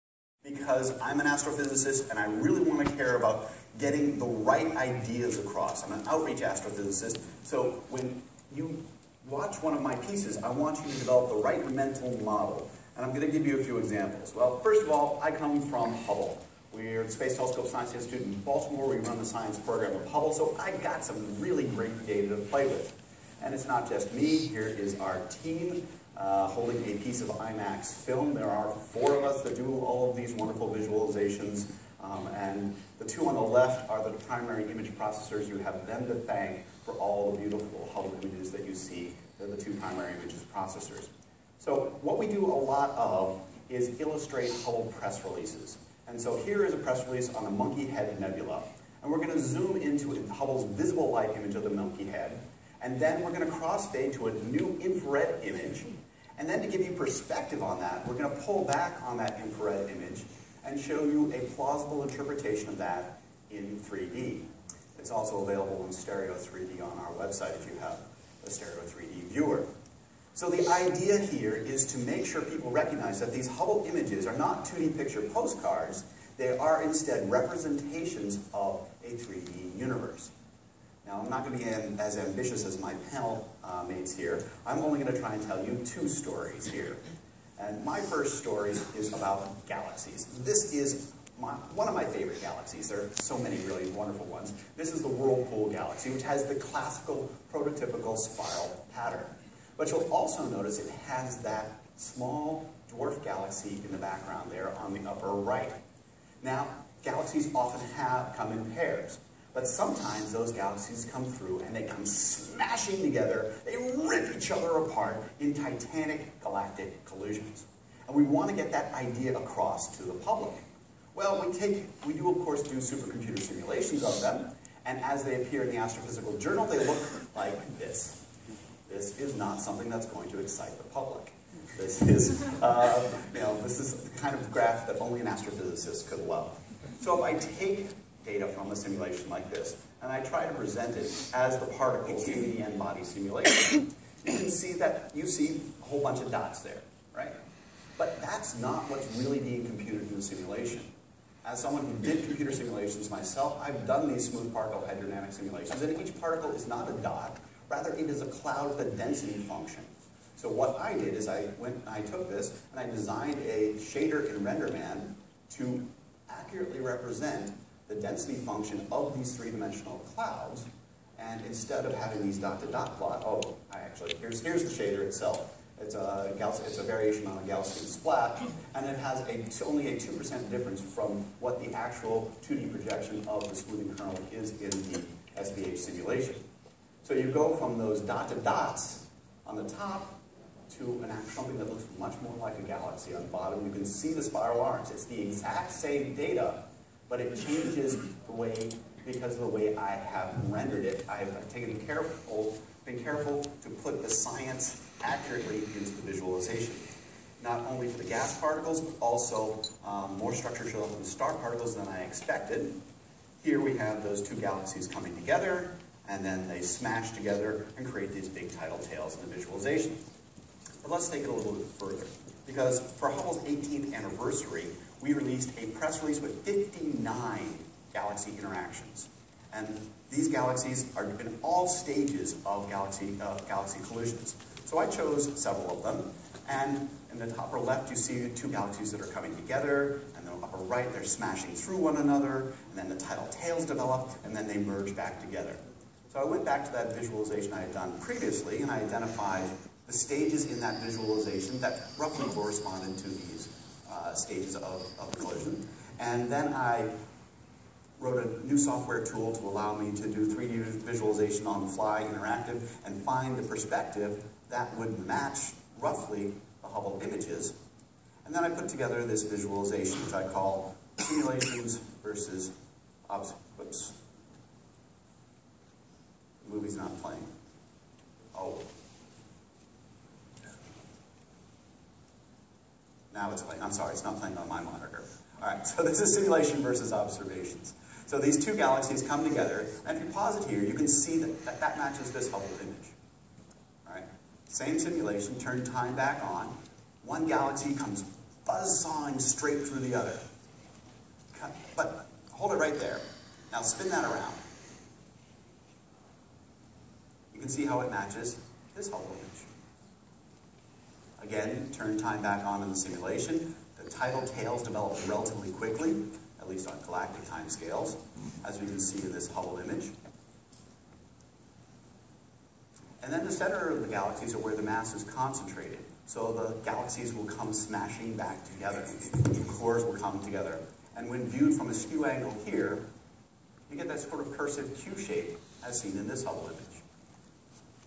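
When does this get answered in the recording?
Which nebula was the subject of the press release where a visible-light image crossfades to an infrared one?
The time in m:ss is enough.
0:47.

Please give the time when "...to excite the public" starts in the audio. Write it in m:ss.
2:10.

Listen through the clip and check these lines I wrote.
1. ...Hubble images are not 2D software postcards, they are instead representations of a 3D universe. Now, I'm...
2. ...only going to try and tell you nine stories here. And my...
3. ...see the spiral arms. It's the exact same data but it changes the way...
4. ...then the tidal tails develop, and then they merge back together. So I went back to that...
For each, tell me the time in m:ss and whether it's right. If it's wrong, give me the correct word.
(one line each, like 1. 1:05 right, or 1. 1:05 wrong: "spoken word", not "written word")
1. 1:13 wrong: "picture", not "software"
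2. 1:24 wrong: "two", not "nine"
3. 3:13 right
4. 4:02 right.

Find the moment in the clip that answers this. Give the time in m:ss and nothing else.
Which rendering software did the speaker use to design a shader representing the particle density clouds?
2:44.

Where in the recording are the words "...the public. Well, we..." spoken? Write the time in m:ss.
2:00.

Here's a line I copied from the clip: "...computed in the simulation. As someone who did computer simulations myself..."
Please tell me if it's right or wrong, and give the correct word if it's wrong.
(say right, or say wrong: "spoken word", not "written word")
right.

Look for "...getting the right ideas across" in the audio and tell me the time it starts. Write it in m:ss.
0:03.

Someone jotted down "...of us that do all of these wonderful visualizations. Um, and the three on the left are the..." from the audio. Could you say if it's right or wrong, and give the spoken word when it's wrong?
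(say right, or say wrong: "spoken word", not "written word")
wrong: "two", not "three".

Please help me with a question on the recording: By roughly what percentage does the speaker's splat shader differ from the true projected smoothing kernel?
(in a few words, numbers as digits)
2%.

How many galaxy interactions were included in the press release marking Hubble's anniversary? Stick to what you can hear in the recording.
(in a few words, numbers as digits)
59.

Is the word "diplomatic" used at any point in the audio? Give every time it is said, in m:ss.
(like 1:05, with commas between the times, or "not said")
not said.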